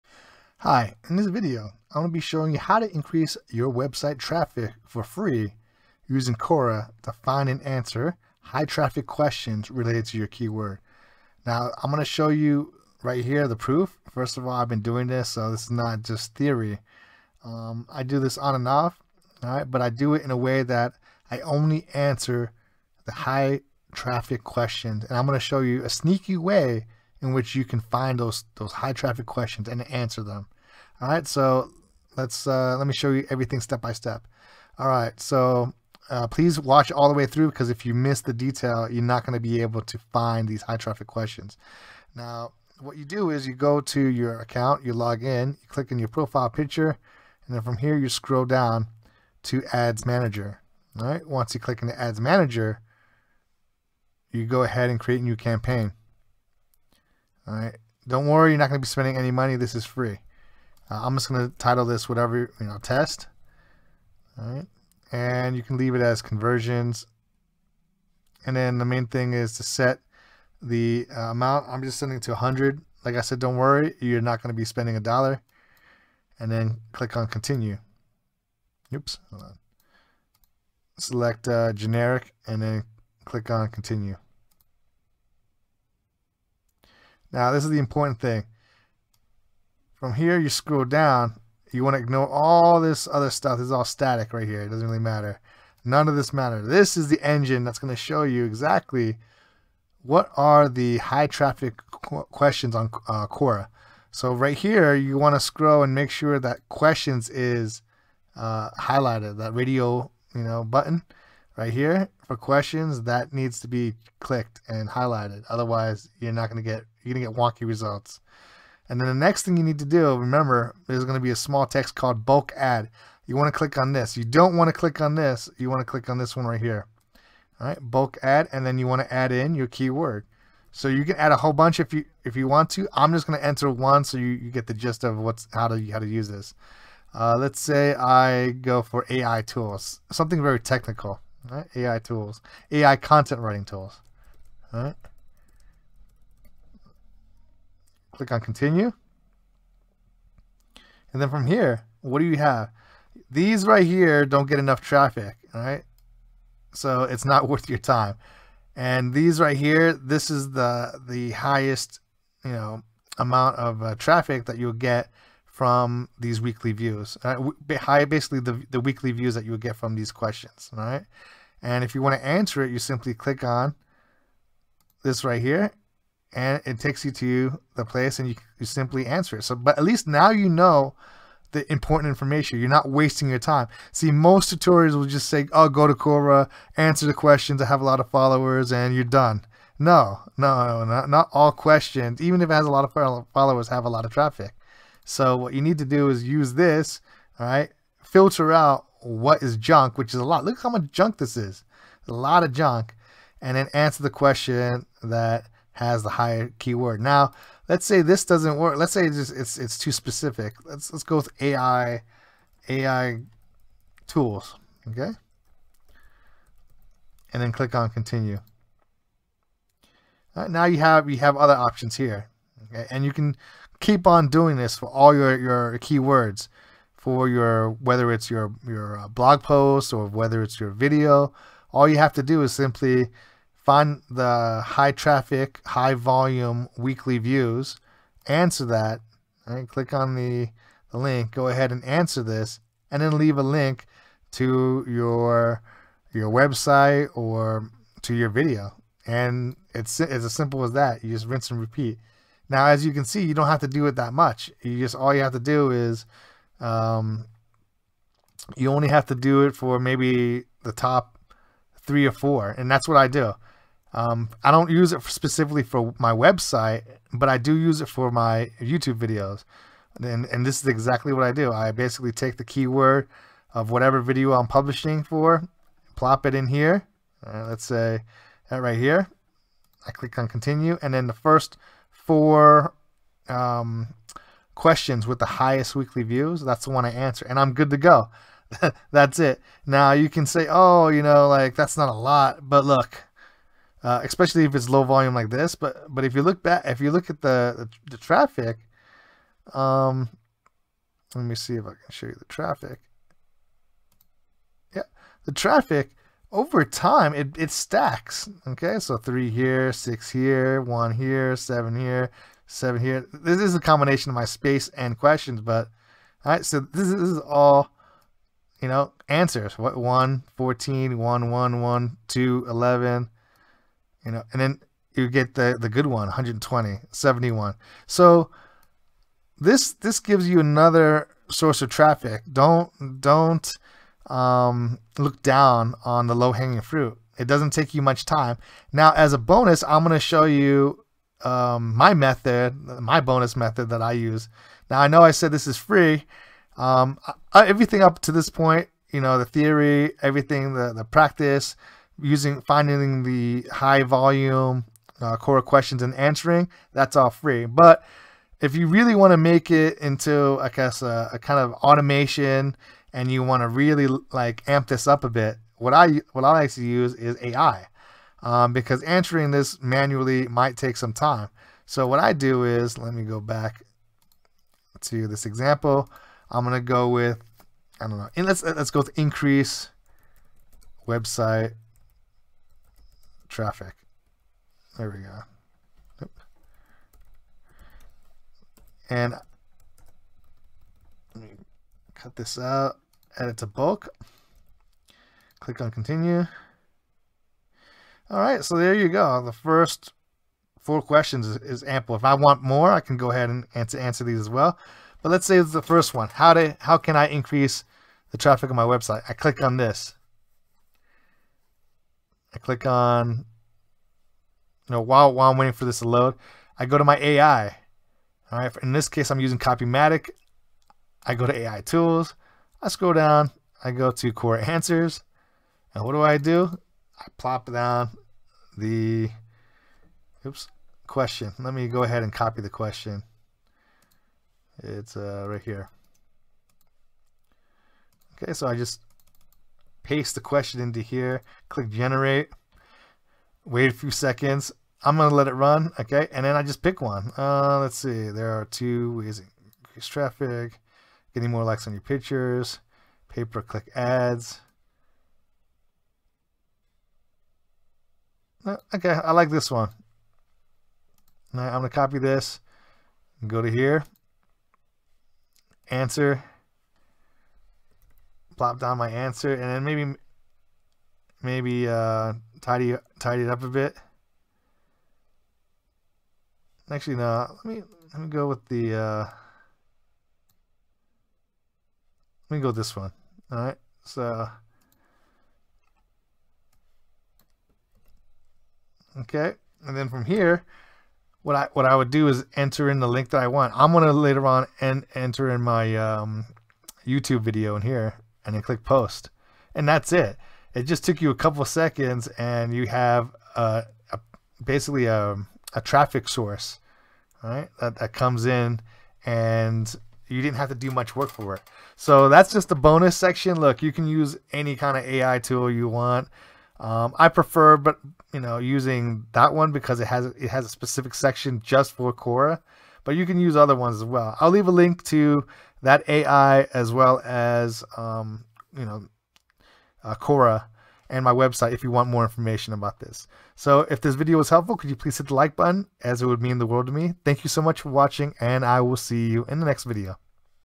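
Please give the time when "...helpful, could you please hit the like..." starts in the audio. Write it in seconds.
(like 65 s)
534 s.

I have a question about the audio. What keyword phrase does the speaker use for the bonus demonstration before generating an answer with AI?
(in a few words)
increase website traffic.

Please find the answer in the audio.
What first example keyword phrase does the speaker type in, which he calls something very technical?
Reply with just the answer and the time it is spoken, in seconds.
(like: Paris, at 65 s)
AI content writing tools, at 142 s.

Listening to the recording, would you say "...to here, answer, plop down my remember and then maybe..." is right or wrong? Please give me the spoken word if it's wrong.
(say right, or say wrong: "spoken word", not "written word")
wrong: "answer", not "remember".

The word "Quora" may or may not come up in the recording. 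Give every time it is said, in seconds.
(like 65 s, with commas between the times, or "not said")
6 s, 103 s, 185 s, 355 s, 424 s, 521 s, 529 s.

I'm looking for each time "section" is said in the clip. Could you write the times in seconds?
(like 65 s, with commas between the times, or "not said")
512 s, 520 s.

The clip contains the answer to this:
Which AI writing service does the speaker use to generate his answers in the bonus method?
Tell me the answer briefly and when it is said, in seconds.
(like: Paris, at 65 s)
Copymatic, at 419 s.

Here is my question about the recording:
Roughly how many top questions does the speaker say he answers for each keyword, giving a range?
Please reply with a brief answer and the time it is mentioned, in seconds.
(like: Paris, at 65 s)
three or four, at 260 s.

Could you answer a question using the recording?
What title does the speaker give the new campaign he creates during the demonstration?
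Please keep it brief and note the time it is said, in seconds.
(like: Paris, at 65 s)
test, at 62 s.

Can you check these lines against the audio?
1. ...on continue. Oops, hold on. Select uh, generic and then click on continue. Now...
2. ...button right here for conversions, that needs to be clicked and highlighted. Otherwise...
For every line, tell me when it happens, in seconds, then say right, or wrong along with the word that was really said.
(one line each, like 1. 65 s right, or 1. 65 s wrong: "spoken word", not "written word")
1. 77 s right
2. 110 s wrong: "questions", not "conversions".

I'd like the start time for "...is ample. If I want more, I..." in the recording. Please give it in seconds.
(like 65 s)
401 s.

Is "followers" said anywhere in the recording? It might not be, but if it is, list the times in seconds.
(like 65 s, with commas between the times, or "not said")
188 s, 193 s.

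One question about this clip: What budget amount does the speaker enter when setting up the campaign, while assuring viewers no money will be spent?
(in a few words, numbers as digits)
100.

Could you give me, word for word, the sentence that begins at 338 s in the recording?
Now, as a bonus, I'm going to show you, um, my method, my bonus method that I use.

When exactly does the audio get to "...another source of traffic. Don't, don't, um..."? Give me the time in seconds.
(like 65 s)
330 s.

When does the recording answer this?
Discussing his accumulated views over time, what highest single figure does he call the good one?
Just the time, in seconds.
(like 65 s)
326 s.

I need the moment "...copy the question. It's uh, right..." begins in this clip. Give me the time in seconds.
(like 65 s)
432 s.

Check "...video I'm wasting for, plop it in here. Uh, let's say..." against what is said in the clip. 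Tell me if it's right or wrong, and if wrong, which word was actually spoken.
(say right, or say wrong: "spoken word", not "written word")
wrong: "publishing", not "wasting".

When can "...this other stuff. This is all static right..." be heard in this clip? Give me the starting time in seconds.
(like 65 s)
92 s.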